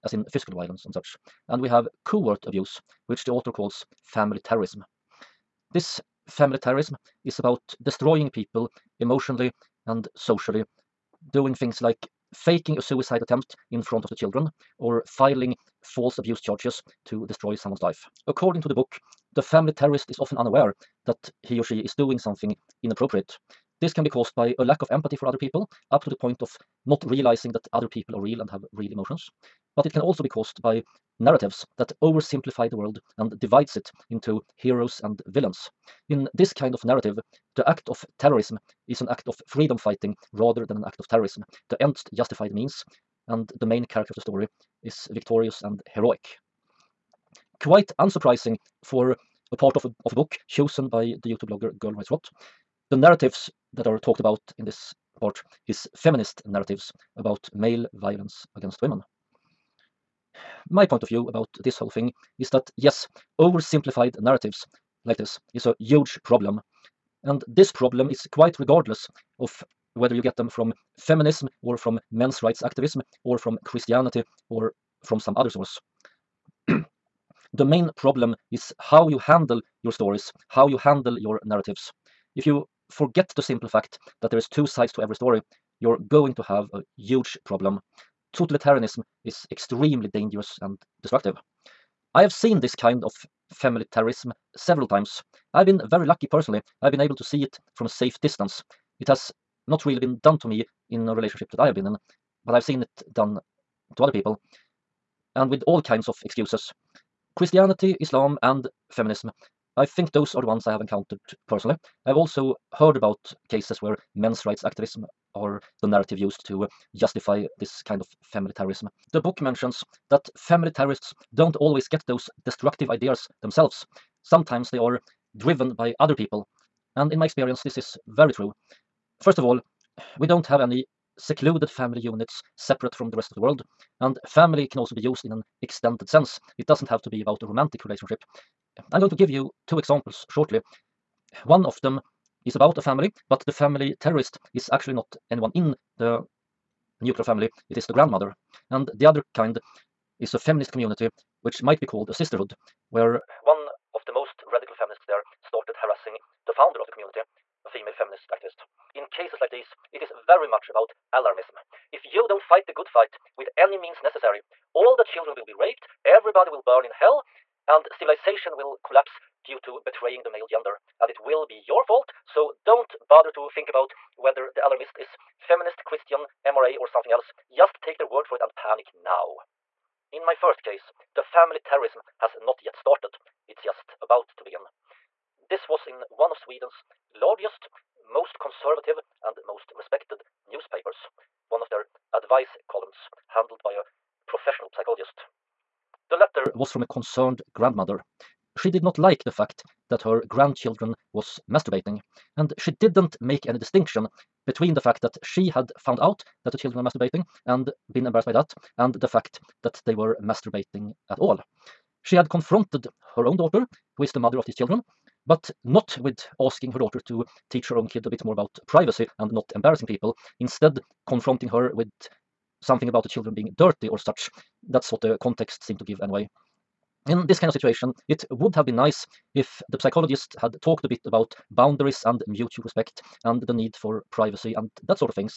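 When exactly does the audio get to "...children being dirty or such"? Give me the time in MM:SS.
03:43.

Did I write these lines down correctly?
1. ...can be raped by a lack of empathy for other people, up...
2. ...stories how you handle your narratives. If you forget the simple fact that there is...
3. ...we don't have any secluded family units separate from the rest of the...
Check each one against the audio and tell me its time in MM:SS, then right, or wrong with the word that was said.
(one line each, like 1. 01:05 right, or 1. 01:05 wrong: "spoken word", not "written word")
1. 00:23 wrong: "caused", not "raped"
2. 01:19 right
3. 02:10 right.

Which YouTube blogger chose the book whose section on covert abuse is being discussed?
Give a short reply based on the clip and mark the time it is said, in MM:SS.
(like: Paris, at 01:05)
Girl Writes Rot, at 00:51.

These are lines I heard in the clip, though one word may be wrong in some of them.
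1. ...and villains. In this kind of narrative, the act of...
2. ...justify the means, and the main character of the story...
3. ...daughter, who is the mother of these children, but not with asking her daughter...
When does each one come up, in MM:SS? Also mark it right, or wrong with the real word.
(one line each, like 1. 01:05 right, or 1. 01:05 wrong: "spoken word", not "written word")
1. 00:35 right
2. 00:42 right
3. 03:33 right.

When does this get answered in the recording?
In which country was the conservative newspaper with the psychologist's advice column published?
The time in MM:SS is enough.
03:06.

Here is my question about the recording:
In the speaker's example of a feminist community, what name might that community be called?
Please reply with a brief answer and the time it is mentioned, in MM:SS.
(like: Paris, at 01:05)
sisterhood, at 02:32.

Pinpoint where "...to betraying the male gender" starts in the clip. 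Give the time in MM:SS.
02:49.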